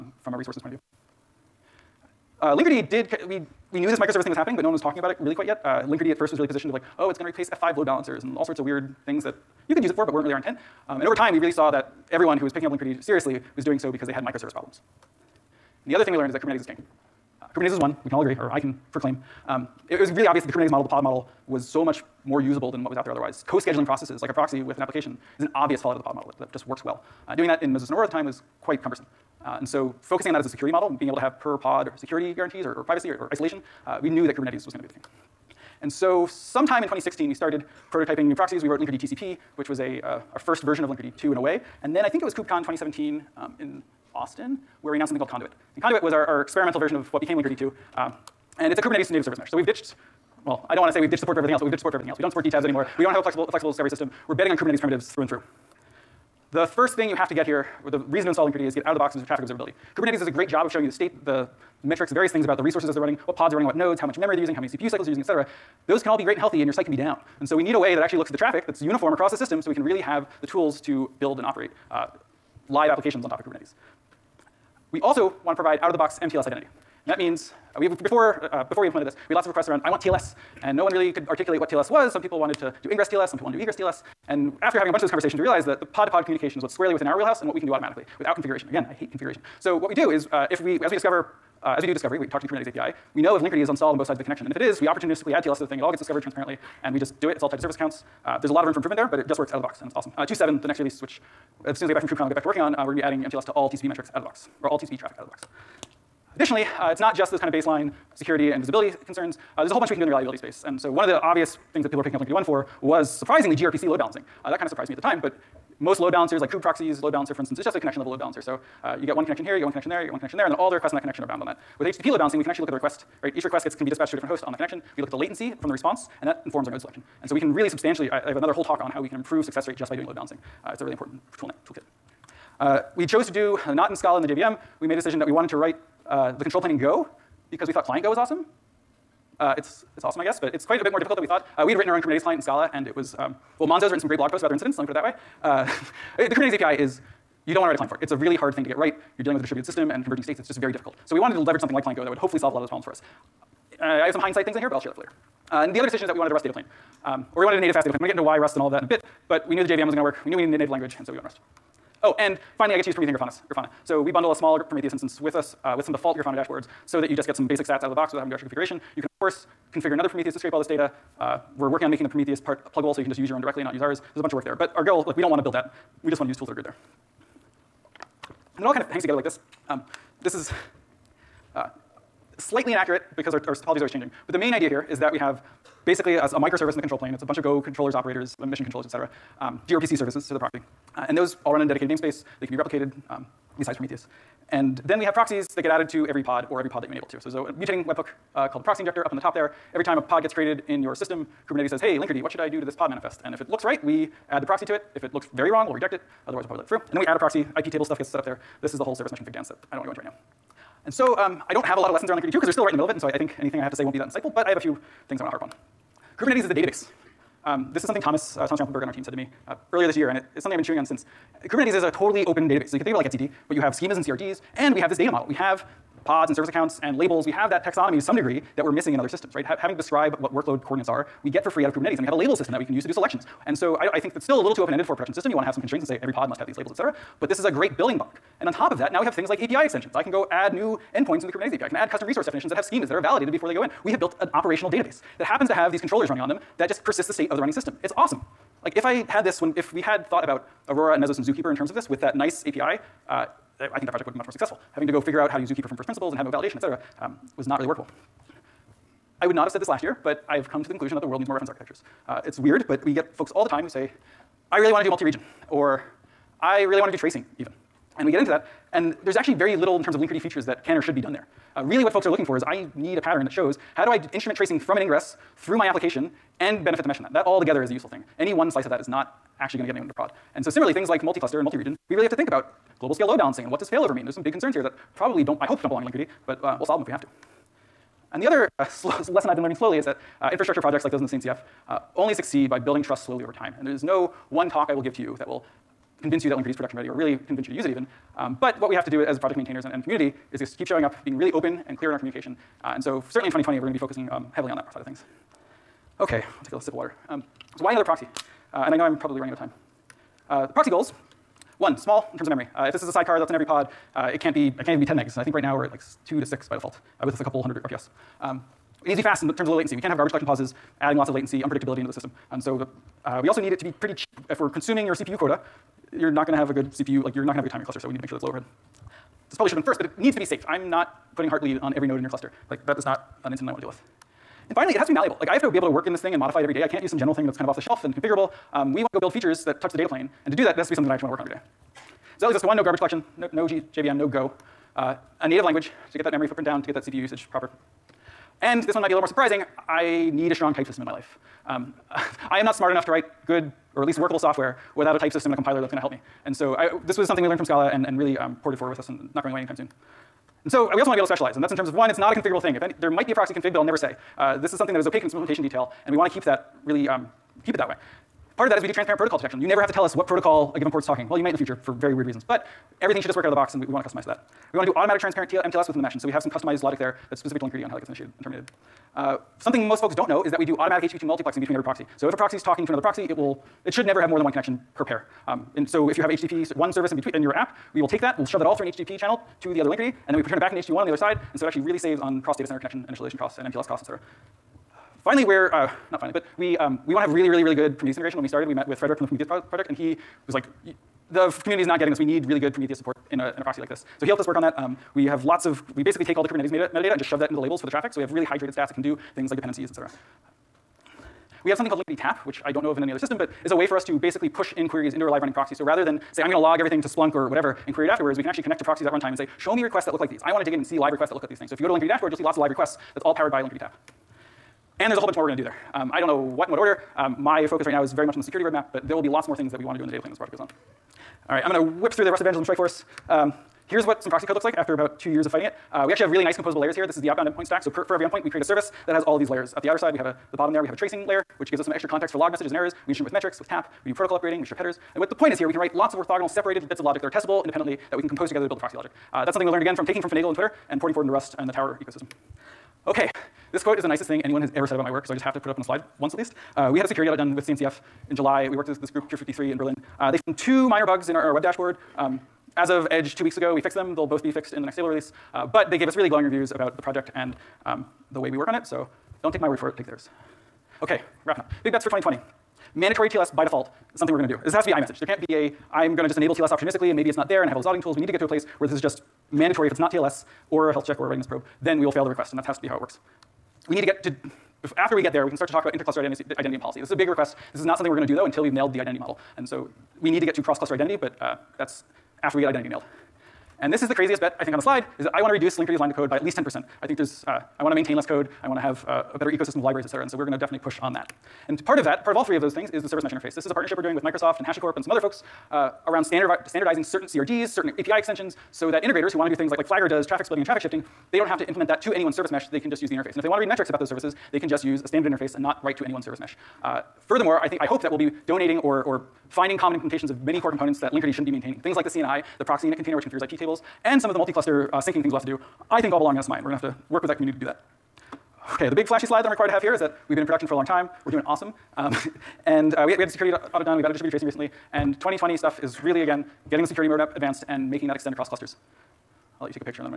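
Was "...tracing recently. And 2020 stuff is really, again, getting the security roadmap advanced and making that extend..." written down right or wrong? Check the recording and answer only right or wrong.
right.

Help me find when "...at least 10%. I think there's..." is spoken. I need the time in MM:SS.
08:16.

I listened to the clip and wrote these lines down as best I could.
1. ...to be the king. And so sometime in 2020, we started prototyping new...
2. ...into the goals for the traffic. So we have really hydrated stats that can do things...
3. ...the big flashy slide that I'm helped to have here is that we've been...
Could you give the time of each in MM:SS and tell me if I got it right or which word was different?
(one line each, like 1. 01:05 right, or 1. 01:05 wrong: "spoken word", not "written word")
1. 00:34 wrong: "2016", not "2020"
2. 06:47 wrong: "labels", not "goals"
3. 08:48 wrong: "required", not "helped".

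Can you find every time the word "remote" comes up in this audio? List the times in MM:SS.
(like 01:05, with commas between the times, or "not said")
not said.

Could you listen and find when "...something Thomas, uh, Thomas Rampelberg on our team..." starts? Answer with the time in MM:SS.
03:37.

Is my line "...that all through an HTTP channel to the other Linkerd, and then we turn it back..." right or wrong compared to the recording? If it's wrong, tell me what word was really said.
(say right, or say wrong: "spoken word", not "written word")
right.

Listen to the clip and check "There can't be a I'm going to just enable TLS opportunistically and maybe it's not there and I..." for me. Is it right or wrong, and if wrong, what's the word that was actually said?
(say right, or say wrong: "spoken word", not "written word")
right.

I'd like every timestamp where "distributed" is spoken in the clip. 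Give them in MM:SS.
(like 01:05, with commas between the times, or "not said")
02:29, 08:53.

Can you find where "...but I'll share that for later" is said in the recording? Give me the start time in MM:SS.
02:34.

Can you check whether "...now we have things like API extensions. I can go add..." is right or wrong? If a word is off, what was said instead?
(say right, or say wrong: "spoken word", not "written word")
right.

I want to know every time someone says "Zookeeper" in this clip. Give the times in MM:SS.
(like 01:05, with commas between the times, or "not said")
04:11, 04:15.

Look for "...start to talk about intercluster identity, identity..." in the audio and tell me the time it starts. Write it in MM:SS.
08:05.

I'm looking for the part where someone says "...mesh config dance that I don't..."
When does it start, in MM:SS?
03:29.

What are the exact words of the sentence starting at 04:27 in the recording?
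And we get into that, and there's actually very little in terms of Linkerd features that can or should be done there.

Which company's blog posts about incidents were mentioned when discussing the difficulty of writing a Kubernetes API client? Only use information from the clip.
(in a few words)
Monzo.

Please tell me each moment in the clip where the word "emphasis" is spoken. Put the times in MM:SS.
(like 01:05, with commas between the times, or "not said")
not said.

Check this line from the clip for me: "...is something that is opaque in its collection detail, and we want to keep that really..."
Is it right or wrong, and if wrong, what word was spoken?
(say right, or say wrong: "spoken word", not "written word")
wrong: "implementation", not "collection".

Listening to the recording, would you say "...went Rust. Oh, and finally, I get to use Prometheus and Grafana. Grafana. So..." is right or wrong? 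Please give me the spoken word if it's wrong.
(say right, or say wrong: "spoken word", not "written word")
right.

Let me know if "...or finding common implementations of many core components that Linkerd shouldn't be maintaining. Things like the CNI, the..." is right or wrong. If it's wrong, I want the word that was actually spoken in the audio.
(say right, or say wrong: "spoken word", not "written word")
right.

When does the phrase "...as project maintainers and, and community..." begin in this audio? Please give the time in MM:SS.
04:59.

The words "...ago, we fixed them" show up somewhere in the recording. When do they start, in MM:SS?
07:43.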